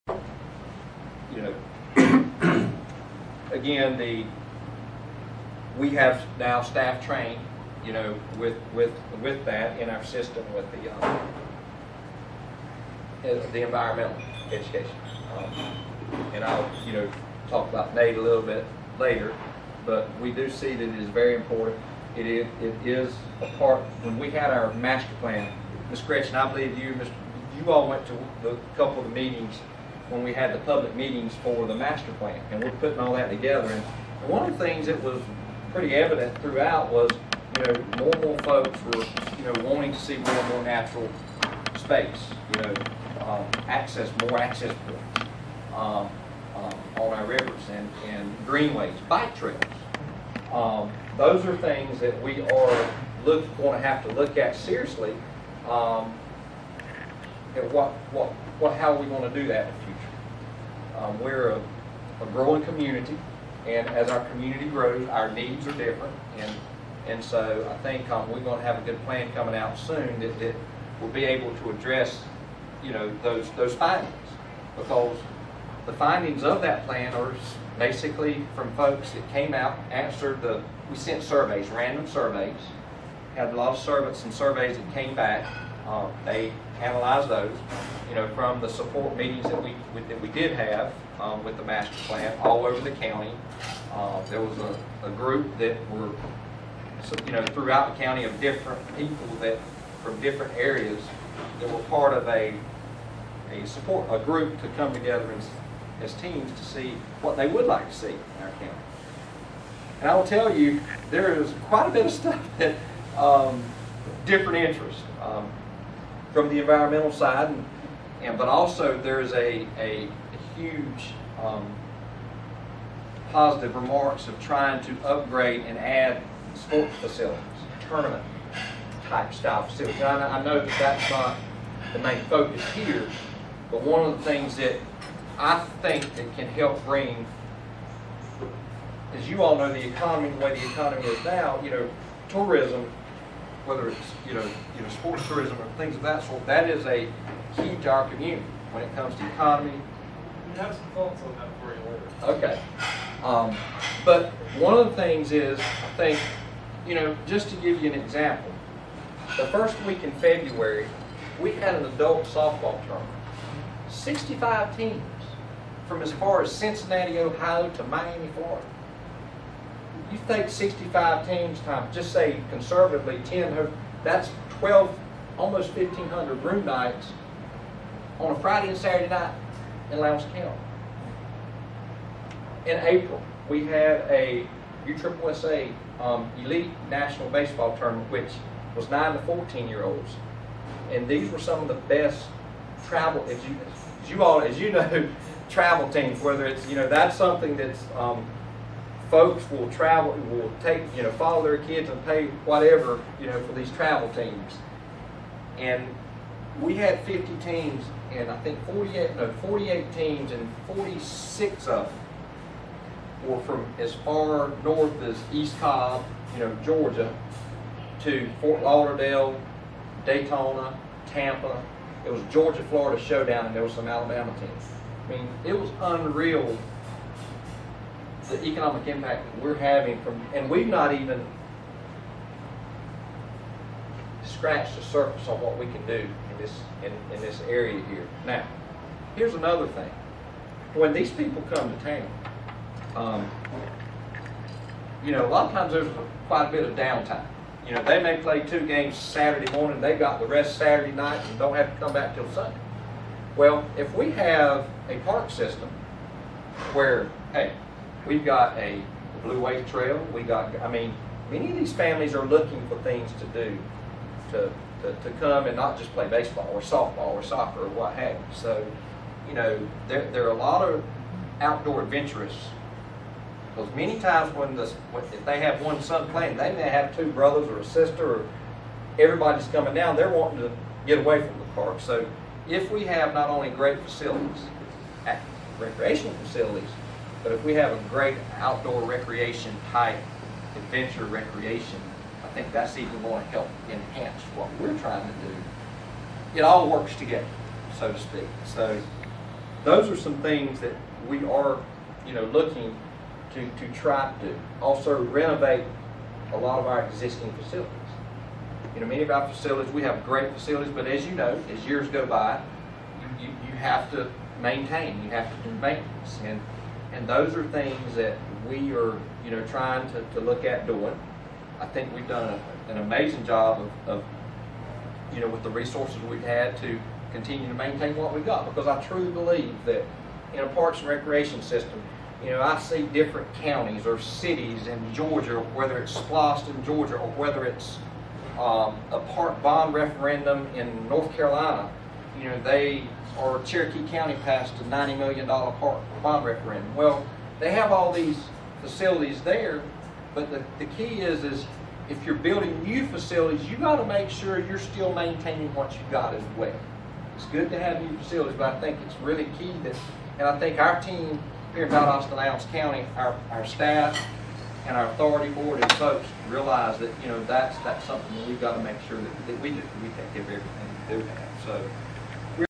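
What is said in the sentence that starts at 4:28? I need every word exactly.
So, you know, there, there are a lot of outdoor adventurous.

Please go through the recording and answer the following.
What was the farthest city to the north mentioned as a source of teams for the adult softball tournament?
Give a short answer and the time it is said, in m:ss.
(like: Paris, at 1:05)
Cincinnati, Ohio, at 2:46.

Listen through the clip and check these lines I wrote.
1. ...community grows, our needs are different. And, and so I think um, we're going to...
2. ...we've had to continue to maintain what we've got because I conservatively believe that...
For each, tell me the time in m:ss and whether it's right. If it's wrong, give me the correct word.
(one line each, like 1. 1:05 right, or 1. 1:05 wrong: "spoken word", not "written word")
1. 1:04 right
2. 5:26 wrong: "truly", not "conservatively".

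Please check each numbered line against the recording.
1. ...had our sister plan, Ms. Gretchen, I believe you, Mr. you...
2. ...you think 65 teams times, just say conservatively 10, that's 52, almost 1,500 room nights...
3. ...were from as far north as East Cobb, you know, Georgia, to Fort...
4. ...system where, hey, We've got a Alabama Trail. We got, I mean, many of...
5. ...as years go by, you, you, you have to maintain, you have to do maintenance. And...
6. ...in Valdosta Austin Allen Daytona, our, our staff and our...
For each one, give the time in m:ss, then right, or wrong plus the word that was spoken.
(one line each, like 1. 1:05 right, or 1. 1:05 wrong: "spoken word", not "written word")
1. 0:24 wrong: "master", not "sister"
2. 2:50 wrong: "12", not "52"
3. 3:33 right
4. 4:15 wrong: "Blueway", not "Alabama"
5. 5:11 right
6. 6:01 wrong: "County", not "Daytona".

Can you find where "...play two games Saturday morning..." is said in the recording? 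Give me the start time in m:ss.
4:08.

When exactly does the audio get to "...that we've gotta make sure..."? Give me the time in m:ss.
6:08.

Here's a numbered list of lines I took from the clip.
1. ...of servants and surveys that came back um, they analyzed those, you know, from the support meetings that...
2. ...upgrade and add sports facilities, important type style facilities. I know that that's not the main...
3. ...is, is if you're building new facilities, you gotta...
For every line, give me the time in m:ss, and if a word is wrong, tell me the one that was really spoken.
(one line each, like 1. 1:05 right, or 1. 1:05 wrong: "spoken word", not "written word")
1. 1:23 right
2. 2:05 wrong: "tournament", not "important"
3. 5:51 right.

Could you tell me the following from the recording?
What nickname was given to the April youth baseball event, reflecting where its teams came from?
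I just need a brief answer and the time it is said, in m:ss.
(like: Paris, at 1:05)
Georgia-Florida showdown, at 3:42.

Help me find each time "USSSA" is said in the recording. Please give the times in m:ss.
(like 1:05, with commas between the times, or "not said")
3:04.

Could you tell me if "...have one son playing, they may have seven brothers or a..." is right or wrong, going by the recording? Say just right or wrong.
wrong.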